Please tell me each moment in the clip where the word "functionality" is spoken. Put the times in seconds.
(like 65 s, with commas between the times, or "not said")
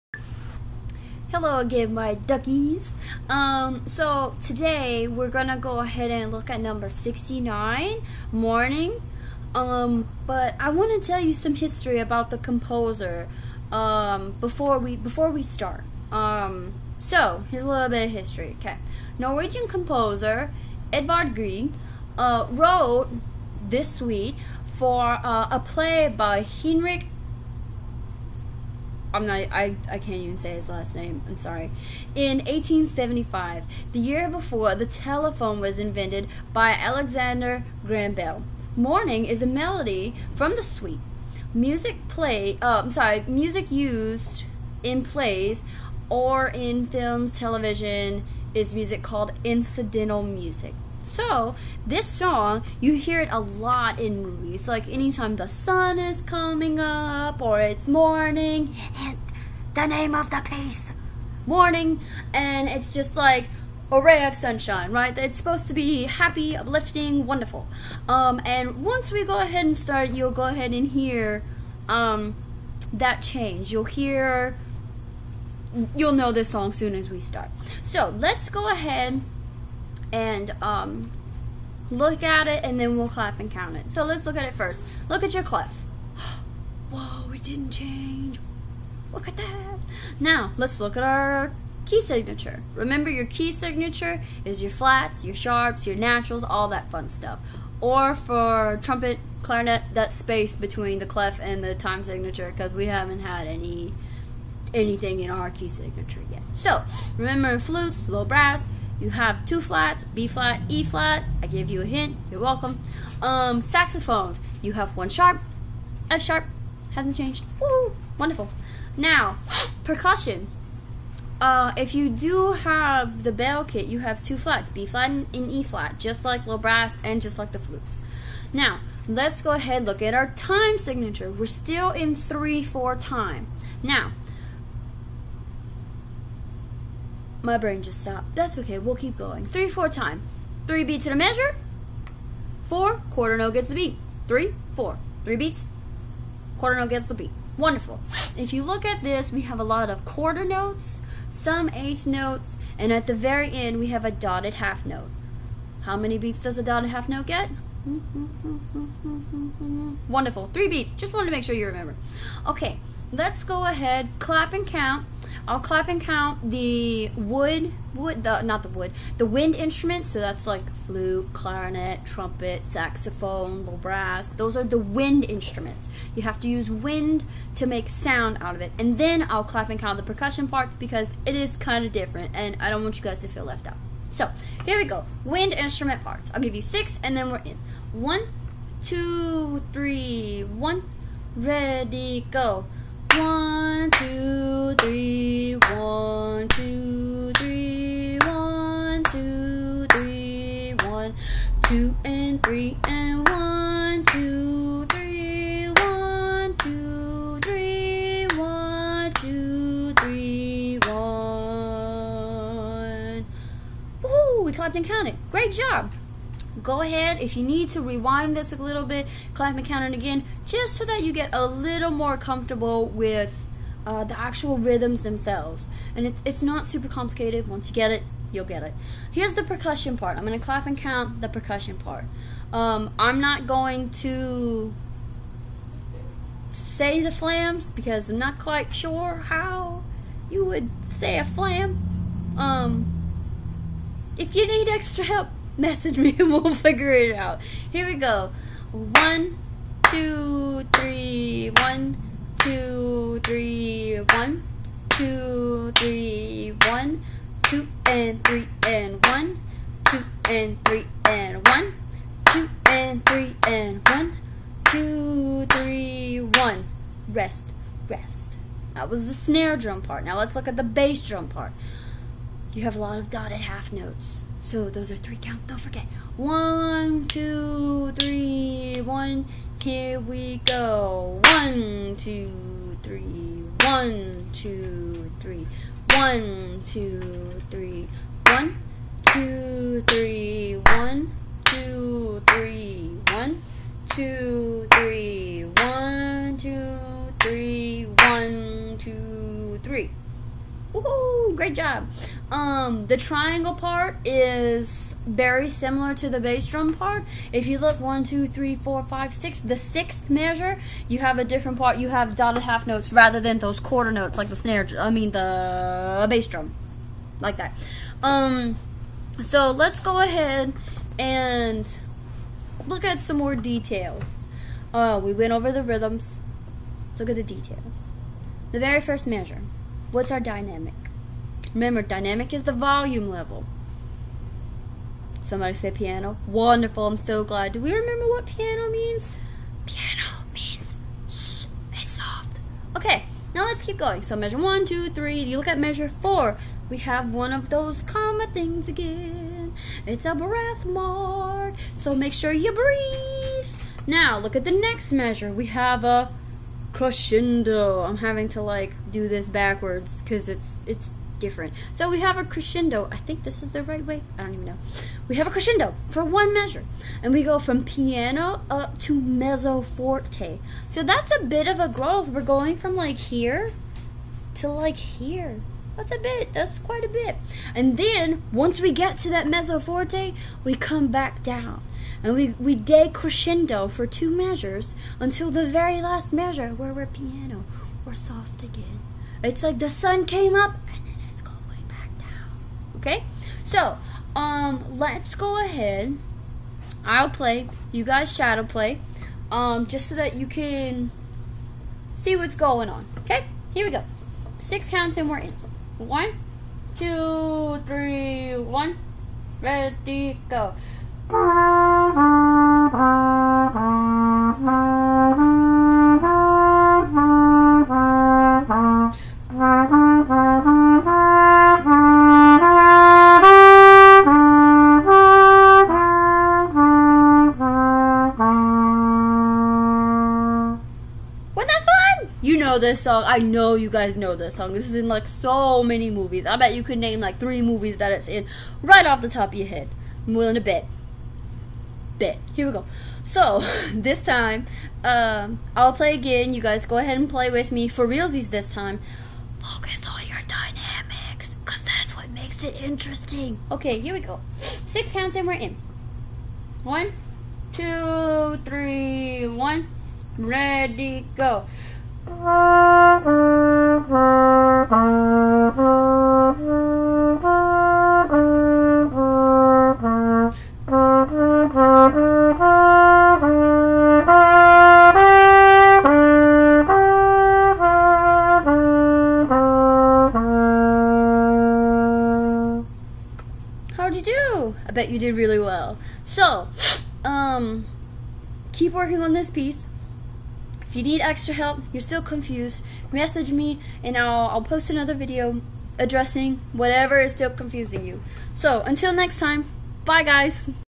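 not said.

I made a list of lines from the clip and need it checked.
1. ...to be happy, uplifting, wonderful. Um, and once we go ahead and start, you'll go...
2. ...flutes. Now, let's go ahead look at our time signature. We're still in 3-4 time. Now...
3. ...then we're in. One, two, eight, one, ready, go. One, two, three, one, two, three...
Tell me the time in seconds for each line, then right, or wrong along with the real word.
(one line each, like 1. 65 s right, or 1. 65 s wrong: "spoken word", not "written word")
1. 65 s right
2. 127 s right
3. 187 s wrong: "three", not "eight".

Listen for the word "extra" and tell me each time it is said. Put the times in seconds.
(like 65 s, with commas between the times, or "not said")
244 s, 491 s.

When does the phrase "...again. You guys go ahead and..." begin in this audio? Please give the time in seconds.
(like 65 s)
445 s.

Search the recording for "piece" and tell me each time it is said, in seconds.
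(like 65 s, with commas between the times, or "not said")
60 s, 489 s.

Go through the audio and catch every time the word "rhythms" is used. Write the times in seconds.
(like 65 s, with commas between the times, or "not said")
224 s, 325 s.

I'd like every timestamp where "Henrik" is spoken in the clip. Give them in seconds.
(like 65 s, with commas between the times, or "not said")
26 s.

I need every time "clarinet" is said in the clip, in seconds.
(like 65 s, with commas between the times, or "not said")
99 s, 171 s.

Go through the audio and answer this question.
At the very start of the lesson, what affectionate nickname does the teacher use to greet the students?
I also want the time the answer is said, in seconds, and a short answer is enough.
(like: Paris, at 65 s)
duckies, at 2 s.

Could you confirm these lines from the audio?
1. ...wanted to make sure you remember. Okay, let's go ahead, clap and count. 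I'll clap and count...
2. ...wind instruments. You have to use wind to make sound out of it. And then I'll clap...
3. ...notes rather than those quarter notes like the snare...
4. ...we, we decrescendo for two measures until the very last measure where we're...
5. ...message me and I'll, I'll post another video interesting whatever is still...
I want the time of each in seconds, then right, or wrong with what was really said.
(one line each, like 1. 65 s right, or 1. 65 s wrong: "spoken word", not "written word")
1. 161 s right
2. 174 s right
3. 312 s right
4. 382 s right
5. 492 s wrong: "addressing", not "interesting".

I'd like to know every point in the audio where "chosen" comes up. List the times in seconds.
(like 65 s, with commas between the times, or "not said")
not said.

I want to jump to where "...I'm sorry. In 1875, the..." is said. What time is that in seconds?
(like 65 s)
31 s.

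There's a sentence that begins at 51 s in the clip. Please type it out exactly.
So, this song, you hear it a lot in movies.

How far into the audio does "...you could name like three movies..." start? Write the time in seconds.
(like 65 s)
436 s.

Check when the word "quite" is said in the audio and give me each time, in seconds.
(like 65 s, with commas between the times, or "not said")
238 s, 376 s.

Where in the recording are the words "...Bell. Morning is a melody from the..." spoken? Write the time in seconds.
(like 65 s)
38 s.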